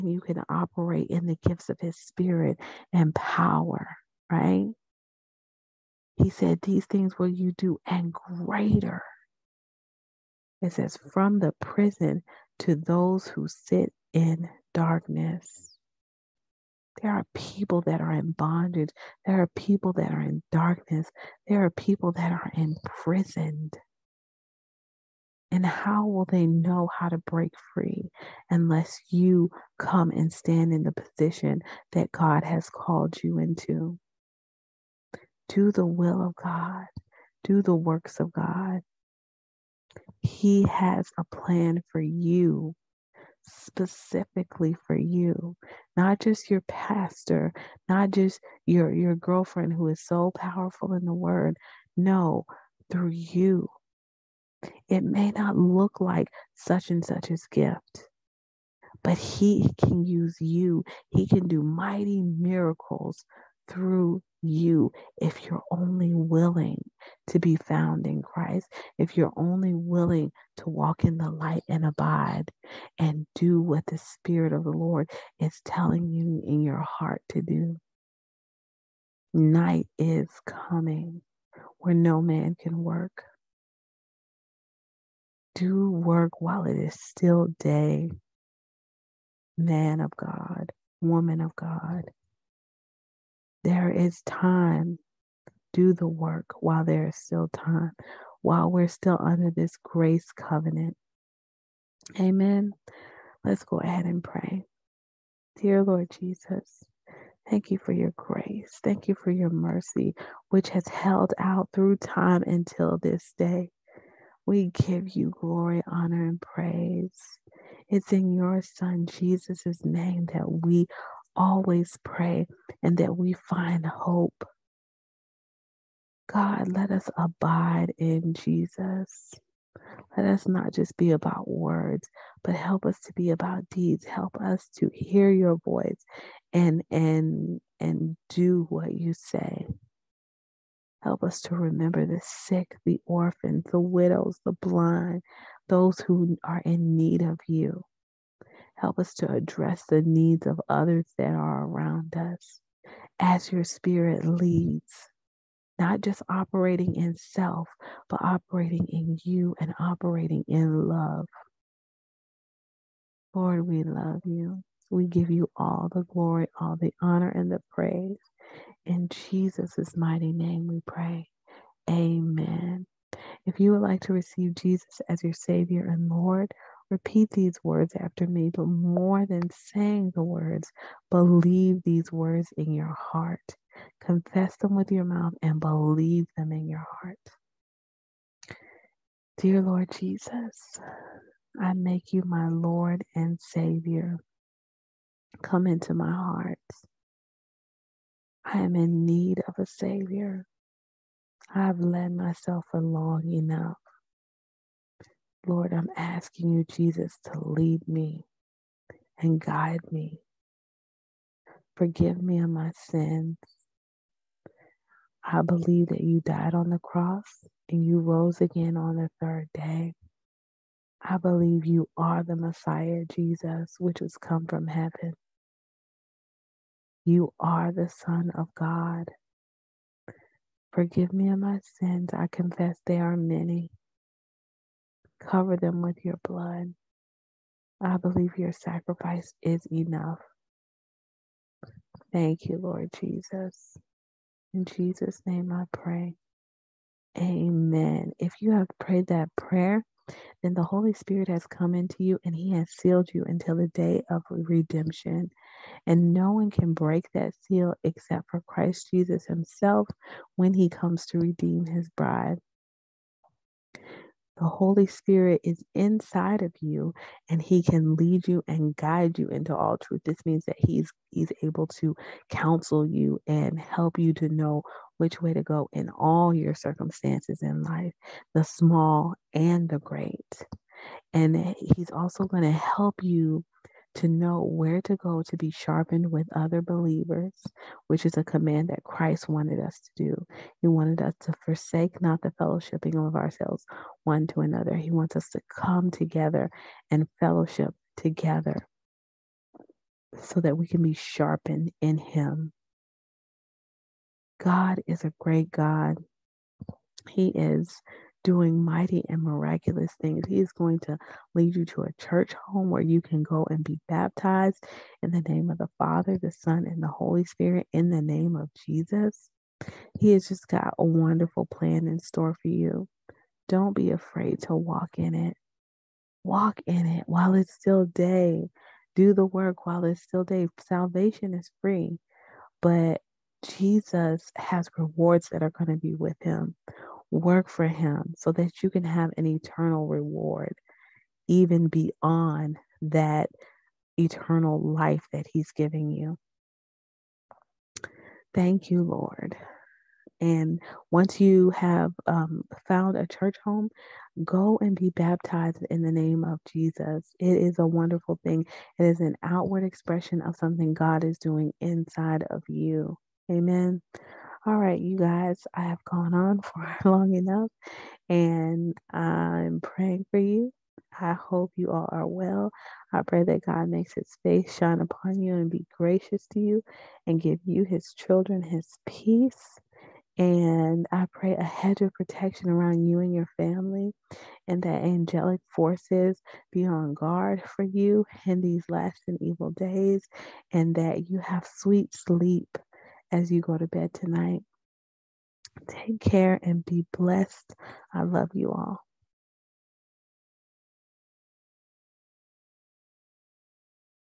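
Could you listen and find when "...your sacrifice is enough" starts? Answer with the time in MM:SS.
03:58.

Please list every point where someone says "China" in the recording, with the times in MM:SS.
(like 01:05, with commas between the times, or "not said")
not said.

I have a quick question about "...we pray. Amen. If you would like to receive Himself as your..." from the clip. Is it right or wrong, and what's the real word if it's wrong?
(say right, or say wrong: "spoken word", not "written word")
wrong: "Jesus", not "Himself".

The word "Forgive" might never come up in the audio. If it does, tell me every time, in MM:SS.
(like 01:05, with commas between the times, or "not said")
03:31, 03:50.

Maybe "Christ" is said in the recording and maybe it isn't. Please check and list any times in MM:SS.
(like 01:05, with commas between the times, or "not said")
01:08, 04:18, 04:48.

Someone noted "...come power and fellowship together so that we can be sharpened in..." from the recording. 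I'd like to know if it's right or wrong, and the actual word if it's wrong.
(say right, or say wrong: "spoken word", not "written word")
wrong: "together", not "power".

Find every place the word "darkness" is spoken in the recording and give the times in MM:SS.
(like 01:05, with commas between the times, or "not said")
00:14, 00:20.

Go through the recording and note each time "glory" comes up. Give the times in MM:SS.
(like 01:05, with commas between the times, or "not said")
01:55, 02:46.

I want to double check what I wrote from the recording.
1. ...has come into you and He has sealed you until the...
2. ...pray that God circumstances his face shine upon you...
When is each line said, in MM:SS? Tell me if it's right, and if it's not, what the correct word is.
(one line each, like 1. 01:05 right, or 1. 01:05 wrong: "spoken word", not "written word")
1. 04:11 right
2. 06:13 wrong: "makes", not "circumstances".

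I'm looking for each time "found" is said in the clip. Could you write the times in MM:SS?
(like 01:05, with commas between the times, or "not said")
01:07, 05:52.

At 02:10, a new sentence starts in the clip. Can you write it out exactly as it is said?
Let us not just be about words, but help us to be about deeds.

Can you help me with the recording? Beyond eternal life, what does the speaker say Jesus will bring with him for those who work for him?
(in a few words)
rewards.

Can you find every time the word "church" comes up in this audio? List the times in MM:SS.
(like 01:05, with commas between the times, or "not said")
05:11, 05:53.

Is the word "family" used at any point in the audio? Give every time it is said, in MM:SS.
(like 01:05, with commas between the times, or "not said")
06:23.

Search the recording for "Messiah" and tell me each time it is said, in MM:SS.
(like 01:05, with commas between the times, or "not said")
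03:42.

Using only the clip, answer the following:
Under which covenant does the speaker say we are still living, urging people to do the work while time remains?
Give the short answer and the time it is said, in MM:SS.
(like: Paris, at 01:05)
grace covenant, at 01:39.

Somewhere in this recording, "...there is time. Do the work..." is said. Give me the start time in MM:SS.
01:33.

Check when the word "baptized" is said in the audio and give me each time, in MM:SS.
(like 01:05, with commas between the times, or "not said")
05:13, 05:54.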